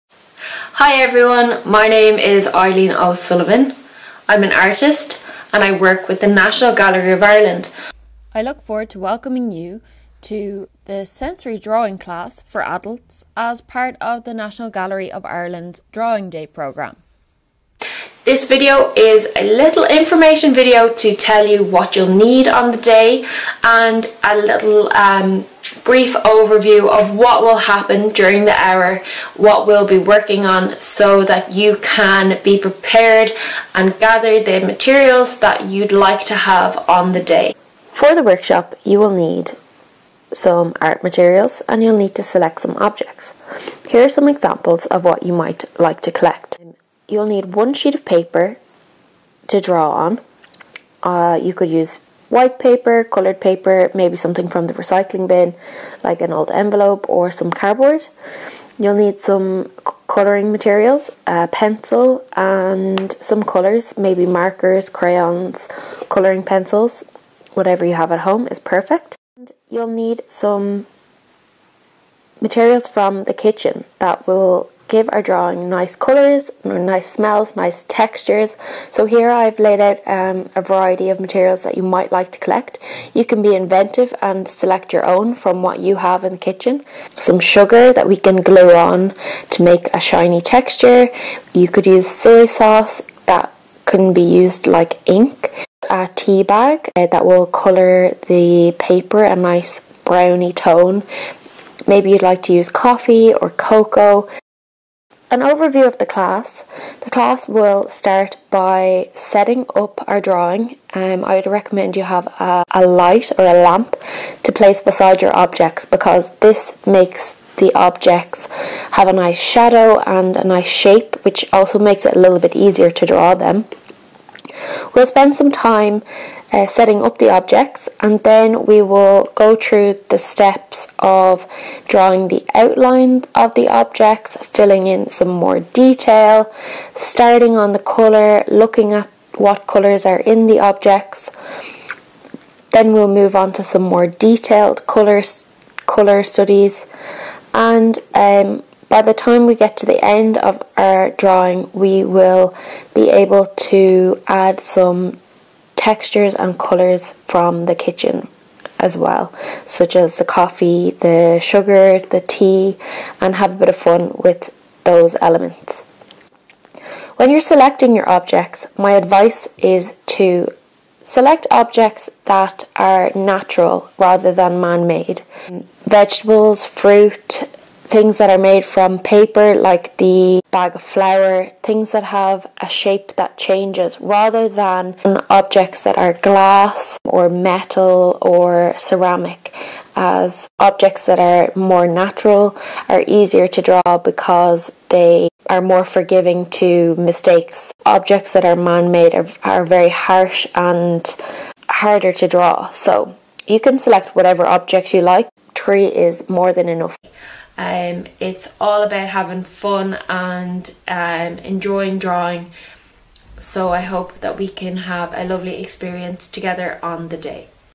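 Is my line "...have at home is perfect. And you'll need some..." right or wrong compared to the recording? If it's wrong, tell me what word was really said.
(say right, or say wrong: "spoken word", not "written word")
right.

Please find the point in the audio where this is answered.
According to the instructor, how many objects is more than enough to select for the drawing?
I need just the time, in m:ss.
3:25.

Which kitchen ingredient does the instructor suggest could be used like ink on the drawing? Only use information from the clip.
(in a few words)
Soy sauce.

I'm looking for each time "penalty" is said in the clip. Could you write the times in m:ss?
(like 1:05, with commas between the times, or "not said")
not said.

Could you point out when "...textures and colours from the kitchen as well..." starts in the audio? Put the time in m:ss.
2:35.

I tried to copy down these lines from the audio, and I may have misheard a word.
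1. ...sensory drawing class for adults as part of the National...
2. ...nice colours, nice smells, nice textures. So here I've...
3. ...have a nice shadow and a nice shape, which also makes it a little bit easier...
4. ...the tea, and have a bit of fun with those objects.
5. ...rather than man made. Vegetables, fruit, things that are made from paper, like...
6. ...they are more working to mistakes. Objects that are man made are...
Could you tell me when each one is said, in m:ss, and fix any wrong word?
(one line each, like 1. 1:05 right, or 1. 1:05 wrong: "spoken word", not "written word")
1. 0:11 right
2. 1:15 right
3. 1:58 right
4. 2:41 wrong: "elements", not "objects"
5. 2:53 right
6. 3:14 wrong: "forgiving", not "working".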